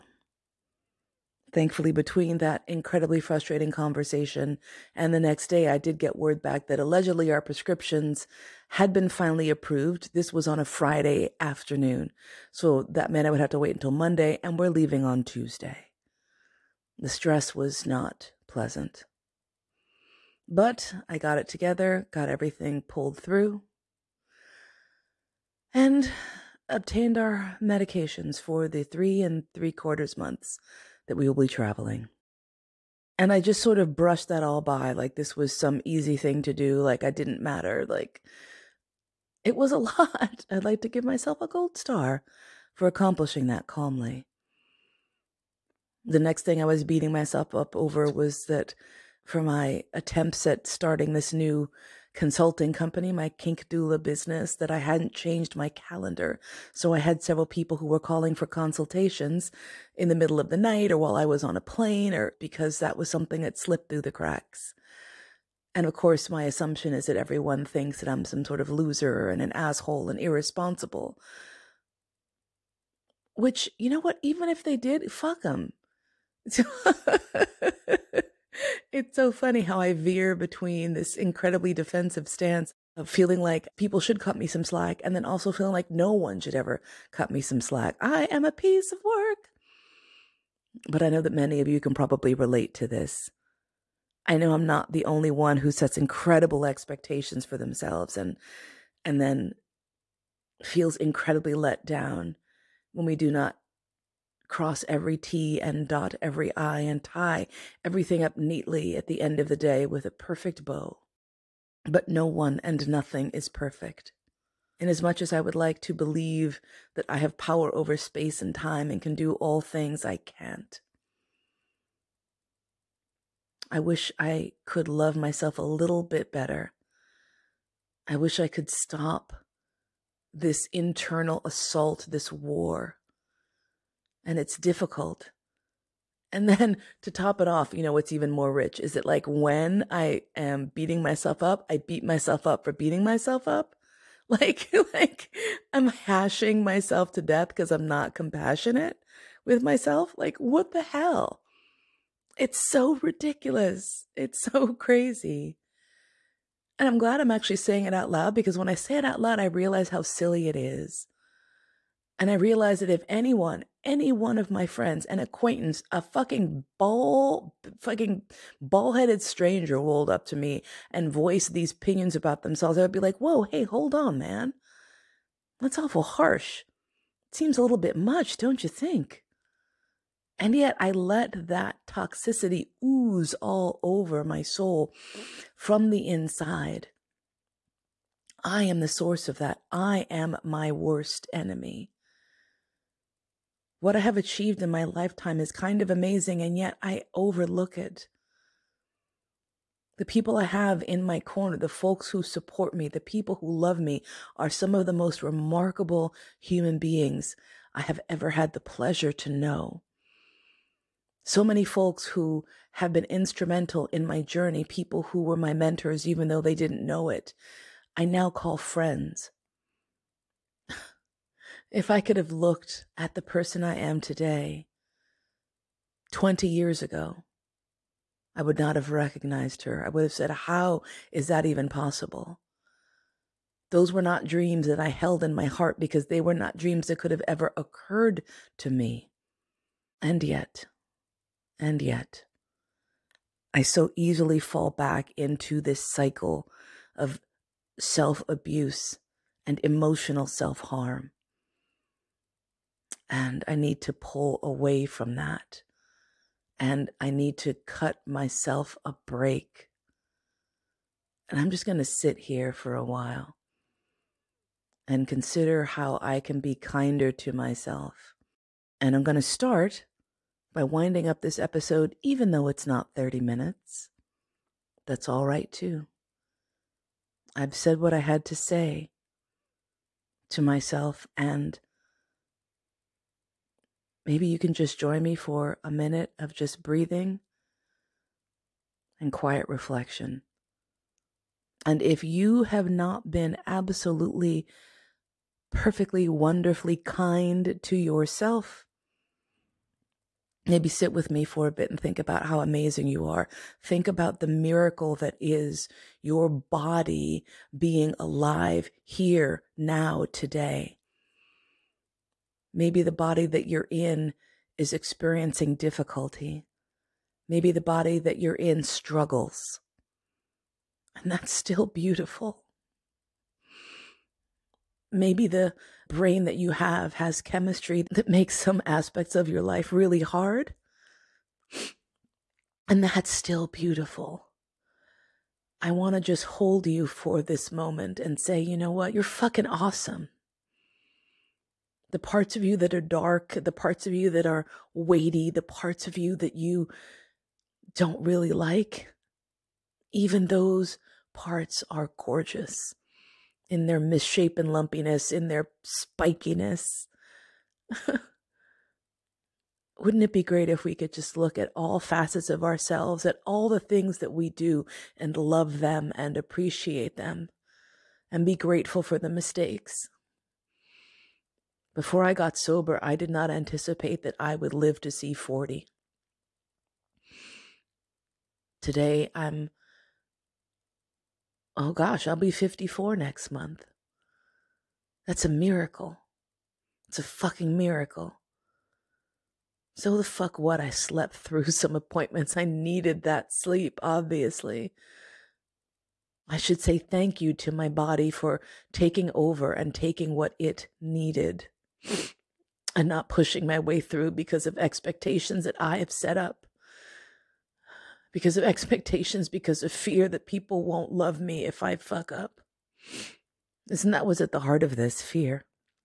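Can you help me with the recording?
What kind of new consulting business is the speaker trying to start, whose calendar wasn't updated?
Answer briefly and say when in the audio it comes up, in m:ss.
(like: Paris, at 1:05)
Kink doula business, at 0:53.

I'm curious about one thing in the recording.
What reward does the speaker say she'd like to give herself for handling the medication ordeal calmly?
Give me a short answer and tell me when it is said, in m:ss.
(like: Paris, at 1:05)
A gold star, at 0:41.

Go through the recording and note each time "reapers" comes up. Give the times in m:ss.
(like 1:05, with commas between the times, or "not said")
not said.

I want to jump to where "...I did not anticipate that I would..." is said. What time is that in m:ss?
6:12.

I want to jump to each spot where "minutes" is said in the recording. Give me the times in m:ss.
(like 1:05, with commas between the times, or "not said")
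4:33, 4:45.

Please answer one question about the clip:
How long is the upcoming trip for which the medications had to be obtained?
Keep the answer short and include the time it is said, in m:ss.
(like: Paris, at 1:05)
3 and 3/4 months, at 0:28.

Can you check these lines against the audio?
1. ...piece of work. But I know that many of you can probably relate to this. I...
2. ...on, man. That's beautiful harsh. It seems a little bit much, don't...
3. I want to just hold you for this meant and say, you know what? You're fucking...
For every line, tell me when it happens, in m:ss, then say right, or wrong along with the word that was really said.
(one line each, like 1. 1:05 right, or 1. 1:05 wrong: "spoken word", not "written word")
1. 1:28 right
2. 2:53 wrong: "awful", not "beautiful"
3. 5:35 wrong: "moment", not "meant".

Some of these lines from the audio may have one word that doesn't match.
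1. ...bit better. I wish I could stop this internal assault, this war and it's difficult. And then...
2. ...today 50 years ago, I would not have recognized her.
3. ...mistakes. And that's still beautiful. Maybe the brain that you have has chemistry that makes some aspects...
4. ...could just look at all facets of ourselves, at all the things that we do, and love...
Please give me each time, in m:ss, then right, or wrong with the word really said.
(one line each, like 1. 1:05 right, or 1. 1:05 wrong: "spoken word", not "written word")
1. 2:06 right
2. 3:43 wrong: "20", not "50"
3. 5:18 wrong: "struggles", not "mistakes"
4. 6:00 right.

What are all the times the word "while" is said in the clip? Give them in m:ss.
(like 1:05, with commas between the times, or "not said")
1:00, 4:22.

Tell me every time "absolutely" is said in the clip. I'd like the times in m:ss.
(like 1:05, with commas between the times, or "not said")
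4:53.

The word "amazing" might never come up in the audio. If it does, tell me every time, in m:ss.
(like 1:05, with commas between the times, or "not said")
3:15, 5:02.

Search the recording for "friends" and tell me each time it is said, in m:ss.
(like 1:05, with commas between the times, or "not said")
2:44, 3:38.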